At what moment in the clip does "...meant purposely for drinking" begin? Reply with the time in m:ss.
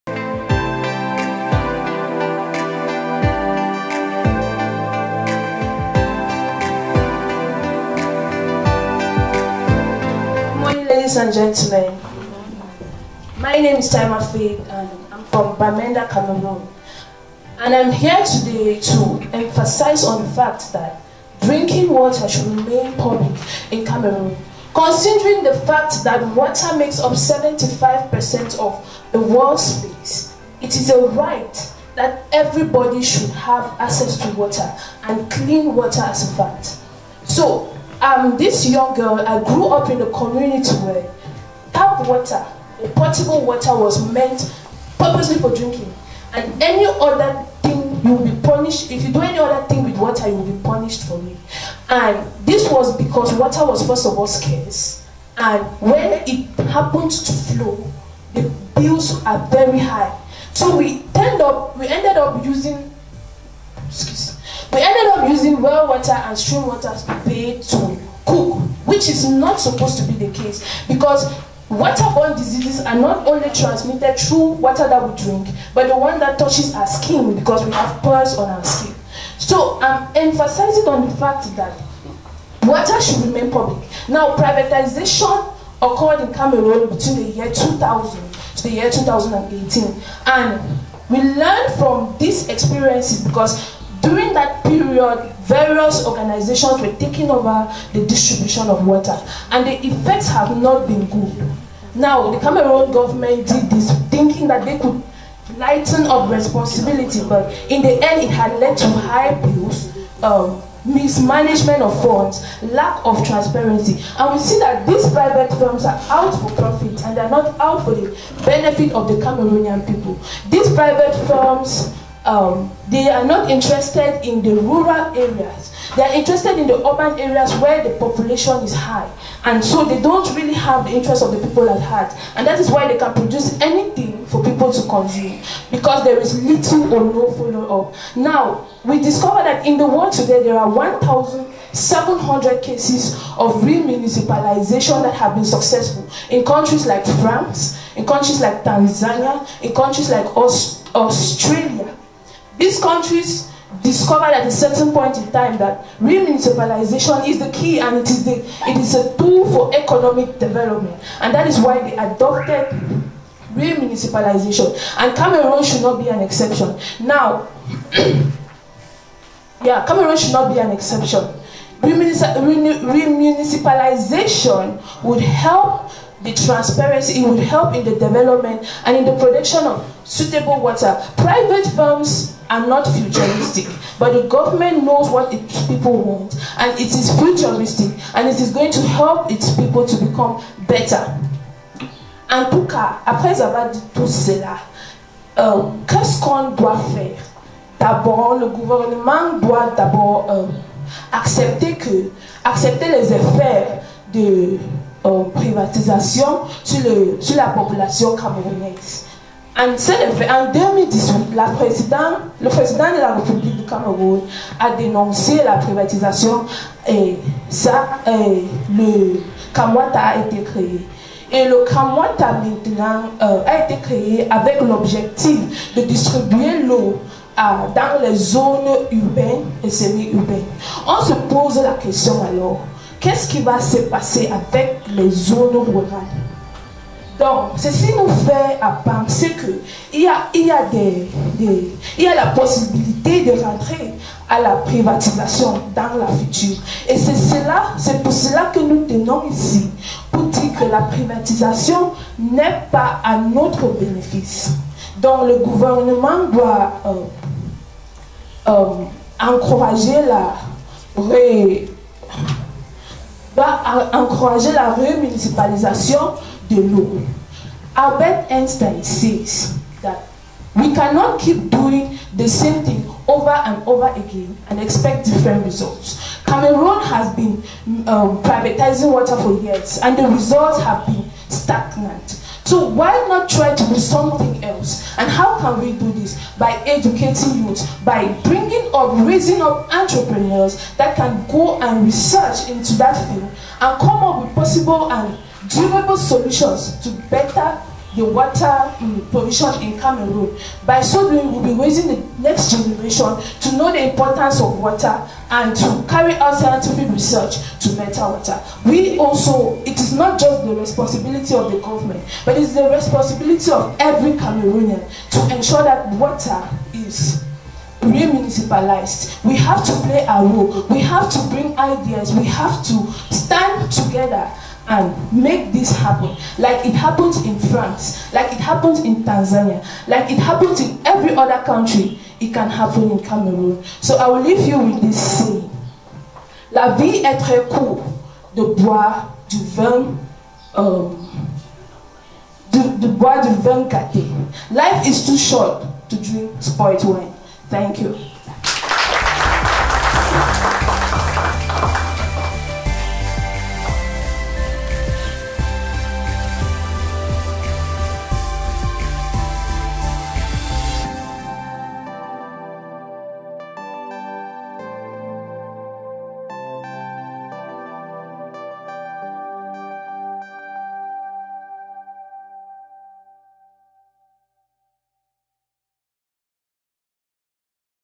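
0:44.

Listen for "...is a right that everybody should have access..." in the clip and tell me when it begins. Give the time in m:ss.
0:30.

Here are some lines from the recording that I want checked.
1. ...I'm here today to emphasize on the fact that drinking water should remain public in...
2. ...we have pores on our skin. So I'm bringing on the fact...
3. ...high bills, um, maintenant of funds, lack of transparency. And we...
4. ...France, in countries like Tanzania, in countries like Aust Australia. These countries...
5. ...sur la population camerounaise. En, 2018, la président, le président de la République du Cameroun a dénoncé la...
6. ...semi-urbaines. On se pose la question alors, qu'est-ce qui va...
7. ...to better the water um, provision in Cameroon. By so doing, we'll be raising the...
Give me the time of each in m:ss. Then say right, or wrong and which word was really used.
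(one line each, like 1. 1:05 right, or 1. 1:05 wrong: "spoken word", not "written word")
1. 0:17 right
2. 1:17 wrong: "emphasizing", not "bringing"
3. 1:48 wrong: "mismanagement", not "maintenant"
4. 2:27 right
5. 3:27 right
6. 3:49 right
7. 4:56 right.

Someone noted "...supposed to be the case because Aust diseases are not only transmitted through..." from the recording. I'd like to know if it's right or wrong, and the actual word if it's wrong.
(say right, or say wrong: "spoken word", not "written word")
wrong: "Waterborne", not "Aust".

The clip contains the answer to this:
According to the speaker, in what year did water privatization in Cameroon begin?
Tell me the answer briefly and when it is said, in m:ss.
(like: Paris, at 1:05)
2000, at 1:27.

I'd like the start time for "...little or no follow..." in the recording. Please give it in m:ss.
2:16.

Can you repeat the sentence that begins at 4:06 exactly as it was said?
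Et c'est cela, c'est pour cela que nous tenons ici, pour dire que la privatisation n'est pas à notre bénéfice.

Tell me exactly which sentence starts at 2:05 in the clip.
They are interested in the urban areas where the population is high.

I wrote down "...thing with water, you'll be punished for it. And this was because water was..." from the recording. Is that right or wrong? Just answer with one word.
right.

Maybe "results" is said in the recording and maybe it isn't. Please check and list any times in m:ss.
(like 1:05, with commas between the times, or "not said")
4:35, 4:40.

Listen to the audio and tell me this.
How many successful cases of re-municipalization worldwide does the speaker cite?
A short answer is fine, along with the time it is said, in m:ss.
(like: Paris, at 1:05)
1,700, at 2:20.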